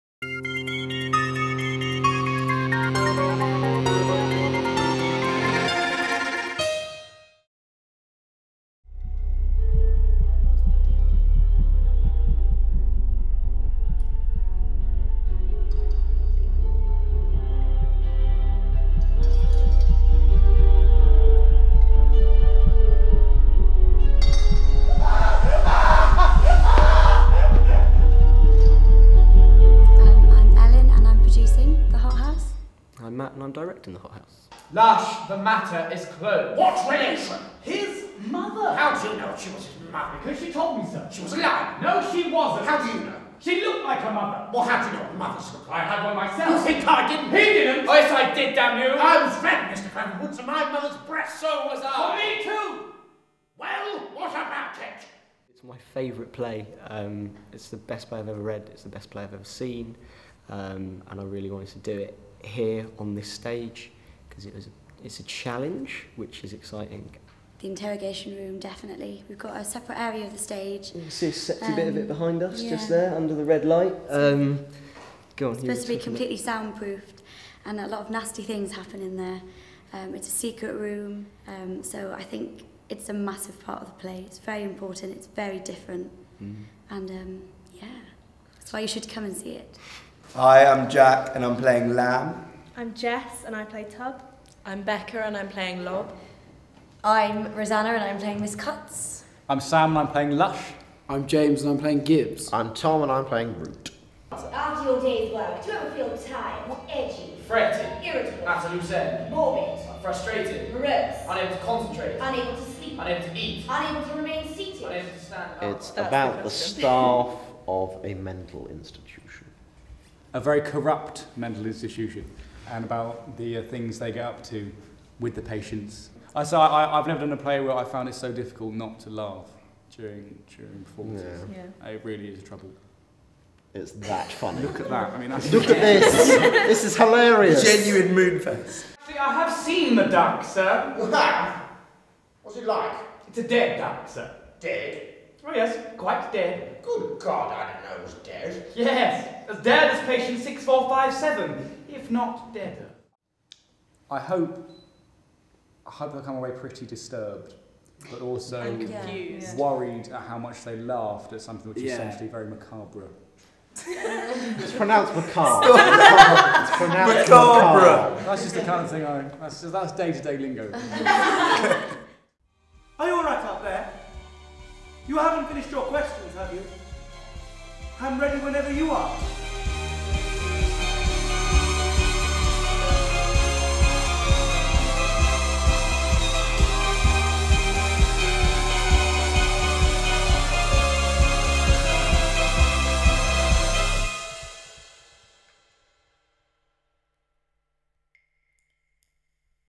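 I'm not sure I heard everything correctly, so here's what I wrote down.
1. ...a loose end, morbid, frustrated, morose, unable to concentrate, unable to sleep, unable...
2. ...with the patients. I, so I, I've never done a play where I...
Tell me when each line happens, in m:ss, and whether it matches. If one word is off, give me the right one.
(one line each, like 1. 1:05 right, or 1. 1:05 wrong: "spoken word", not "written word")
1. 1:48 right
2. 2:05 right.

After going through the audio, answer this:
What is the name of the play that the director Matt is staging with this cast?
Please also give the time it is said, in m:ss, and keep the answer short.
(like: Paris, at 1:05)
The Hothouse, at 0:33.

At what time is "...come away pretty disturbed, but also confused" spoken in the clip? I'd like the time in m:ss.
2:36.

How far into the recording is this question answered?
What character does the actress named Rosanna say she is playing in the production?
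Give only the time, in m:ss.
1:38.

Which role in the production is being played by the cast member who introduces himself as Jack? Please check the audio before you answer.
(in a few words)
Lamb.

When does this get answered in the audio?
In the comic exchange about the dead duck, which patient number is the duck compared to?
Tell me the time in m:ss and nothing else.
2:30.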